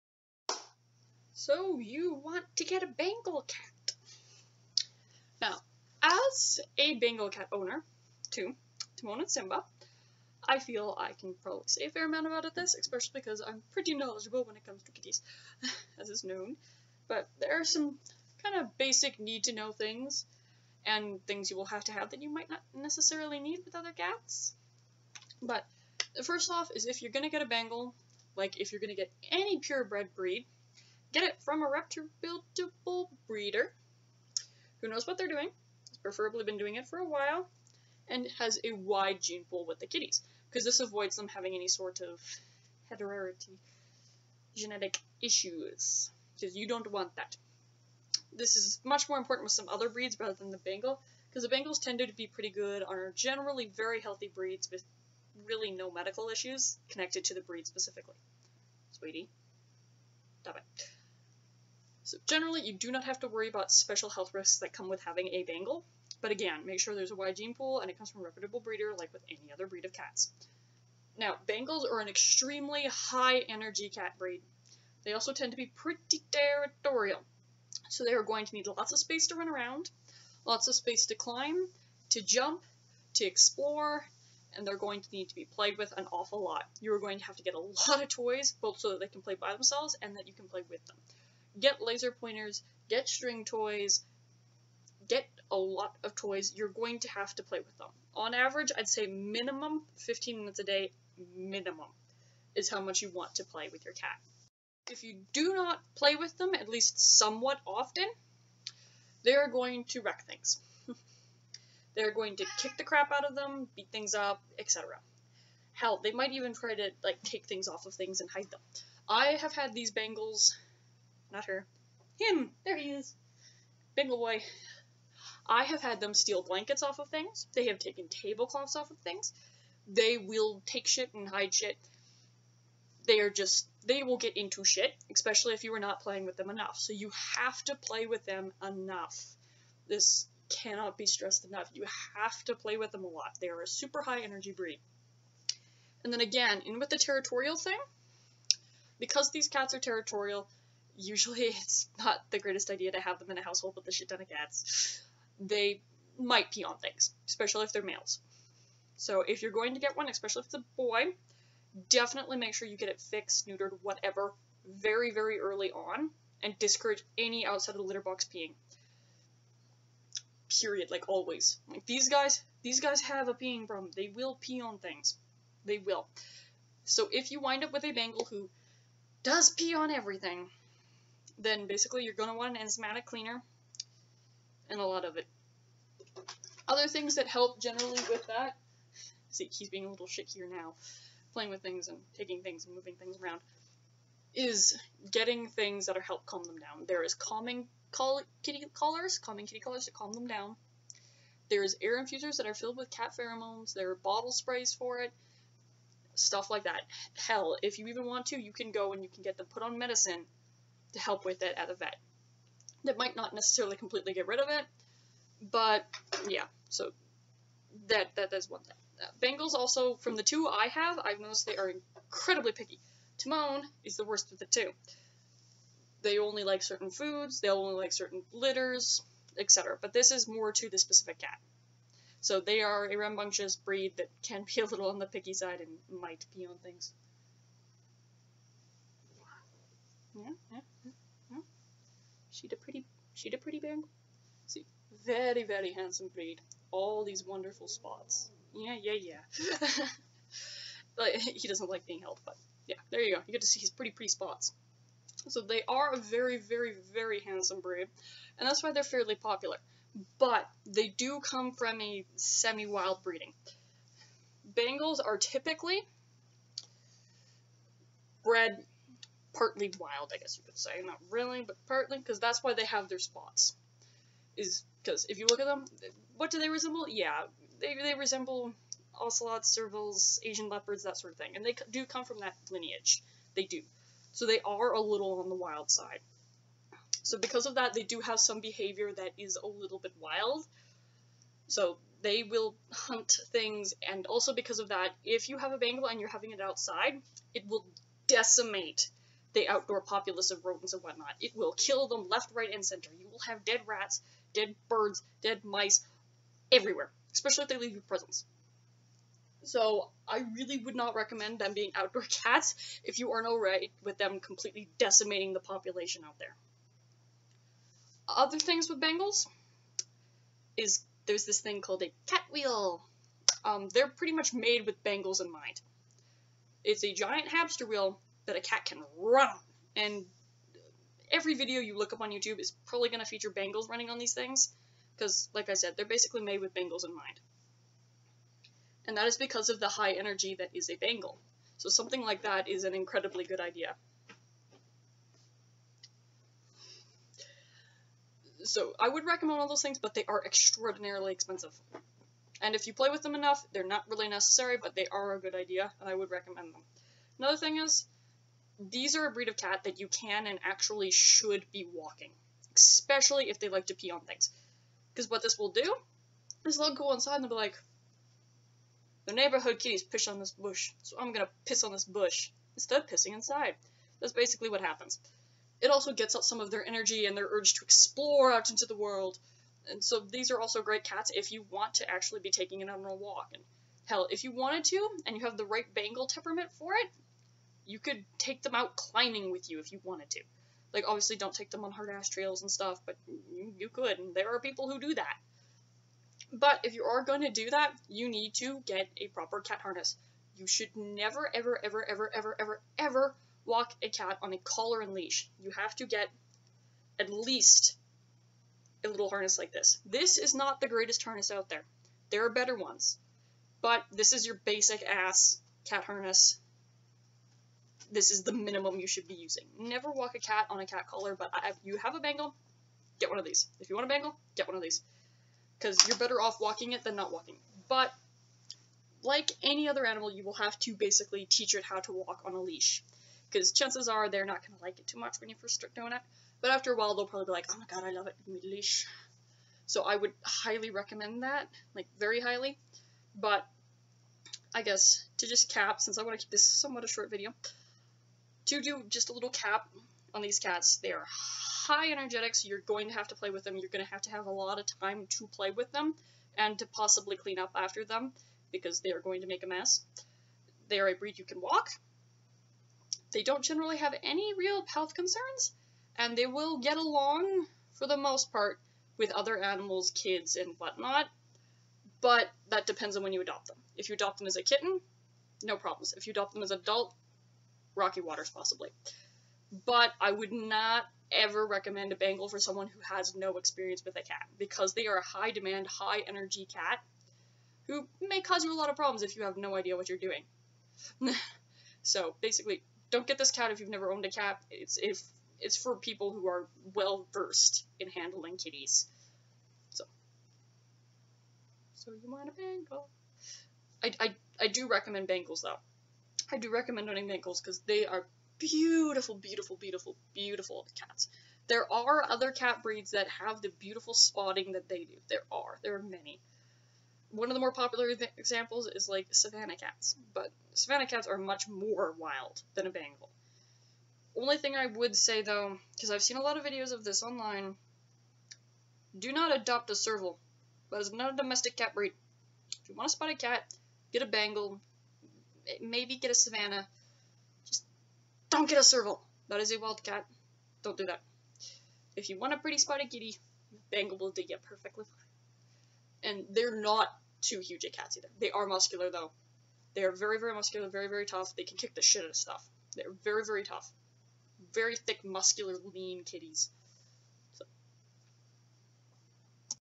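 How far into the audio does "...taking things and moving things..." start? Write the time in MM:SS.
03:12.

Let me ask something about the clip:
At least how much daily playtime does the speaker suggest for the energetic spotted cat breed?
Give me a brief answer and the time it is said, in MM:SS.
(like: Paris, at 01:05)
15 minutes, at 01:39.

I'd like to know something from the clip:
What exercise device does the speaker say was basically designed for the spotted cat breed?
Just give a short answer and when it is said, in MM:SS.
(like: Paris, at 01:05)
cat wheel, at 05:22.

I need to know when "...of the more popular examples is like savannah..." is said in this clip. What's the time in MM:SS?
08:37.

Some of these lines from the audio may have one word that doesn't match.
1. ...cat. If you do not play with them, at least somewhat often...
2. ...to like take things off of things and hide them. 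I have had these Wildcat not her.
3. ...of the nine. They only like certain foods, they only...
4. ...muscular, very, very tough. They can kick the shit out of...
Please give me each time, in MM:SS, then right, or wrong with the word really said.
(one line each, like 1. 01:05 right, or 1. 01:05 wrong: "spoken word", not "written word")
1. 01:43 right
2. 01:56 wrong: "Bengals", not "Wildcat"
3. 03:44 wrong: "two", not "nine"
4. 09:10 right.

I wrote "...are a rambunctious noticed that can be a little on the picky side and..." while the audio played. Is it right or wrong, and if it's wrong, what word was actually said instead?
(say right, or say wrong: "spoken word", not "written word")
wrong: "breed", not "noticed".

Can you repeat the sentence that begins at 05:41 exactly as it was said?
So something like that is an incredibly good idea.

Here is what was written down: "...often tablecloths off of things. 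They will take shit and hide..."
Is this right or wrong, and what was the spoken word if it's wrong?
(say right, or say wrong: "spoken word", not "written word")
wrong: "taken", not "often".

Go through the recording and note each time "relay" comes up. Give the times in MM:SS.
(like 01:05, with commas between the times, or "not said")
not said.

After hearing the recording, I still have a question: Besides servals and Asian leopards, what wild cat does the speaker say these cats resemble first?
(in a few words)
ocelots.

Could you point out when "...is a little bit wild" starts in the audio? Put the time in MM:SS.
04:49.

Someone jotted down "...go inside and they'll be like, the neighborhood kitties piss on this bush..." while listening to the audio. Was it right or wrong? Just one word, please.
right.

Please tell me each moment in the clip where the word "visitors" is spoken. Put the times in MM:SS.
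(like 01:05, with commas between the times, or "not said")
not said.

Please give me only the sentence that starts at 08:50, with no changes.
That is not a domestic cat breed.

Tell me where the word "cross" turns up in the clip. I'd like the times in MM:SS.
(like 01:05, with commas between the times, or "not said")
not said.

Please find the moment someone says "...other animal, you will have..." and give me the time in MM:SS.
07:09.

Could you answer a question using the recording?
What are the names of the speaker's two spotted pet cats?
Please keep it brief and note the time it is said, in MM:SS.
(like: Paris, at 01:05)
Timon and Simba, at 00:08.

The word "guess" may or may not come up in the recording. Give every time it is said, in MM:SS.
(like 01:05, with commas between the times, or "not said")
04:30, 07:24.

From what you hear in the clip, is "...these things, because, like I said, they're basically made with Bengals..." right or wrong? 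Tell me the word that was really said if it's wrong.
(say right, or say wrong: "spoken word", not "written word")
right.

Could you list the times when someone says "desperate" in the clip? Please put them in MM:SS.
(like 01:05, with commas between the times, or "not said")
not said.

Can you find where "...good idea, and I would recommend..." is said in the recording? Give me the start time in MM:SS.
05:55.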